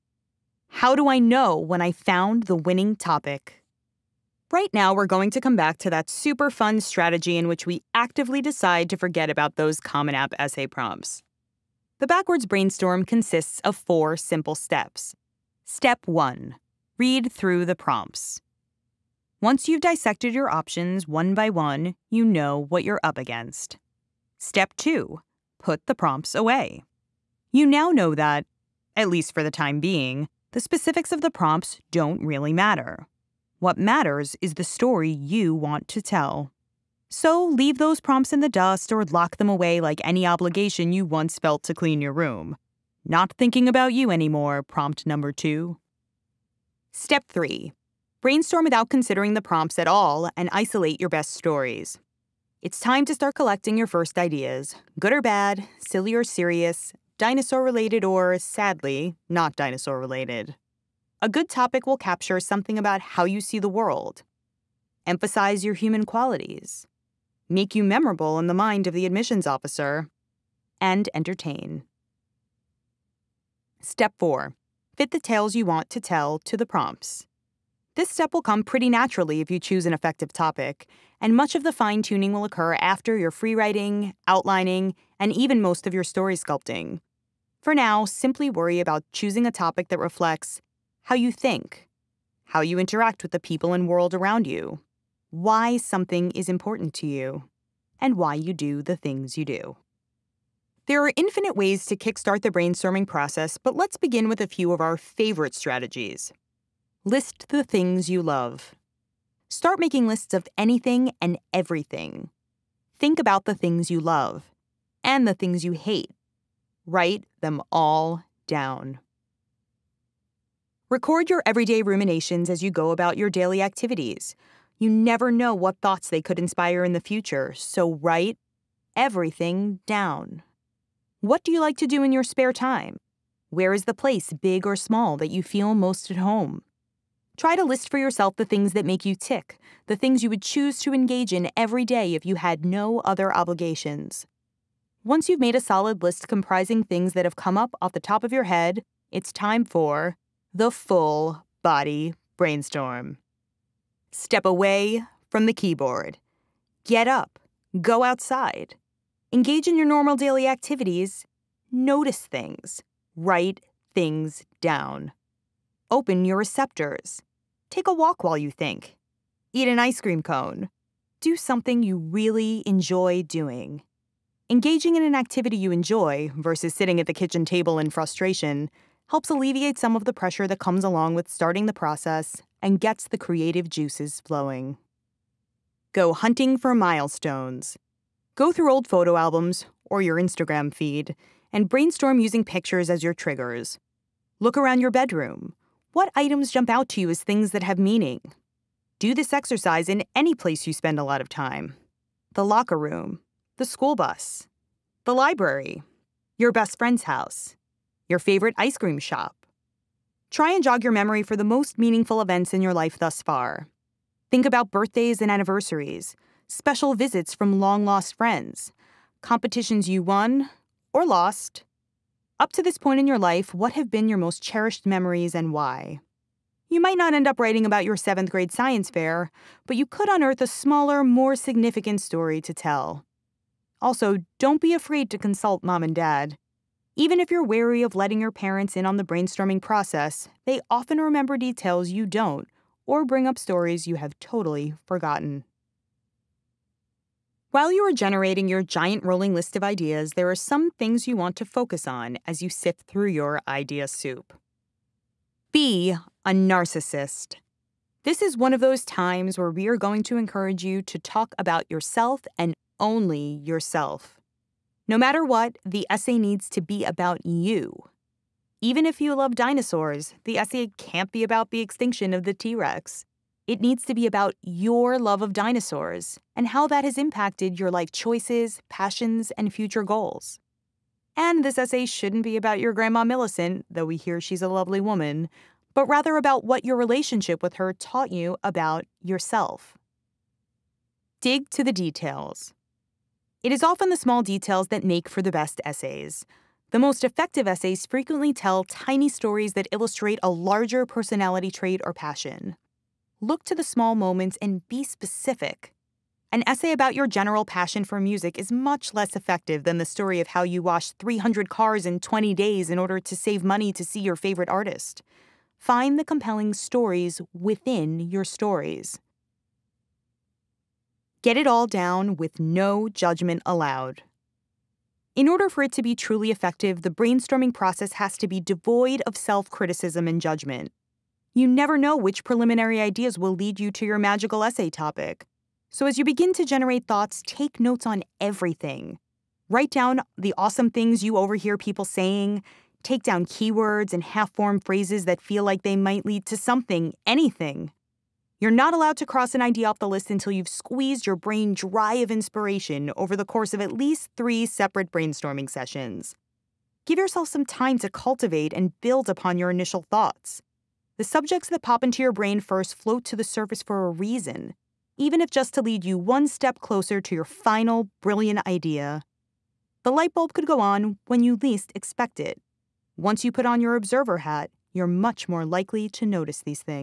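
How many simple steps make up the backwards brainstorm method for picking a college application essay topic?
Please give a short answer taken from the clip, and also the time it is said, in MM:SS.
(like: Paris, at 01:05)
4, at 00:13.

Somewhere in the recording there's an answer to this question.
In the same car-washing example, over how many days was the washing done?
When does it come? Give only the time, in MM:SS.
05:11.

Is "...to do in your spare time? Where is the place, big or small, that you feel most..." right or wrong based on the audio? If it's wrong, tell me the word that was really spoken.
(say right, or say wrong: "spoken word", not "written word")
right.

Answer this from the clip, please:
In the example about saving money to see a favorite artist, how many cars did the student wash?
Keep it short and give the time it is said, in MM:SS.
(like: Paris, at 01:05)
300, at 05:10.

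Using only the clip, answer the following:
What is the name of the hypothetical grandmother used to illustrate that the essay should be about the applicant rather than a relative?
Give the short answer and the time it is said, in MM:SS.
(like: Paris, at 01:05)
Millicent, at 04:43.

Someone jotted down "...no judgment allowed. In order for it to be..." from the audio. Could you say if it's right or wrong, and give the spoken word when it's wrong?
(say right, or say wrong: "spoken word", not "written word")
right.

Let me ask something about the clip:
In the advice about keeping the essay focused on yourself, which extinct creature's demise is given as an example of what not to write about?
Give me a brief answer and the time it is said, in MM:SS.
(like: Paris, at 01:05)
T Rex, at 04:32.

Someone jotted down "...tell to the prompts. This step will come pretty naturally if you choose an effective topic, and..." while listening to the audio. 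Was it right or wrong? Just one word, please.
right.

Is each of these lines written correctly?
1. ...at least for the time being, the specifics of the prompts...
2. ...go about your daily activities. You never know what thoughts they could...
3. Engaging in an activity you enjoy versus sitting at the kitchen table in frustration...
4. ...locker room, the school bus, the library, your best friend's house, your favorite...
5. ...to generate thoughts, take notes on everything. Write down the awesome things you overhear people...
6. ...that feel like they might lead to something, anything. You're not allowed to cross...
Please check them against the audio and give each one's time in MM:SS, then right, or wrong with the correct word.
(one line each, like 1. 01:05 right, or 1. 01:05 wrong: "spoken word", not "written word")
1. 00:28 right
2. 02:02 right
3. 02:54 right
4. 03:22 right
5. 05:36 right
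6. 05:45 right.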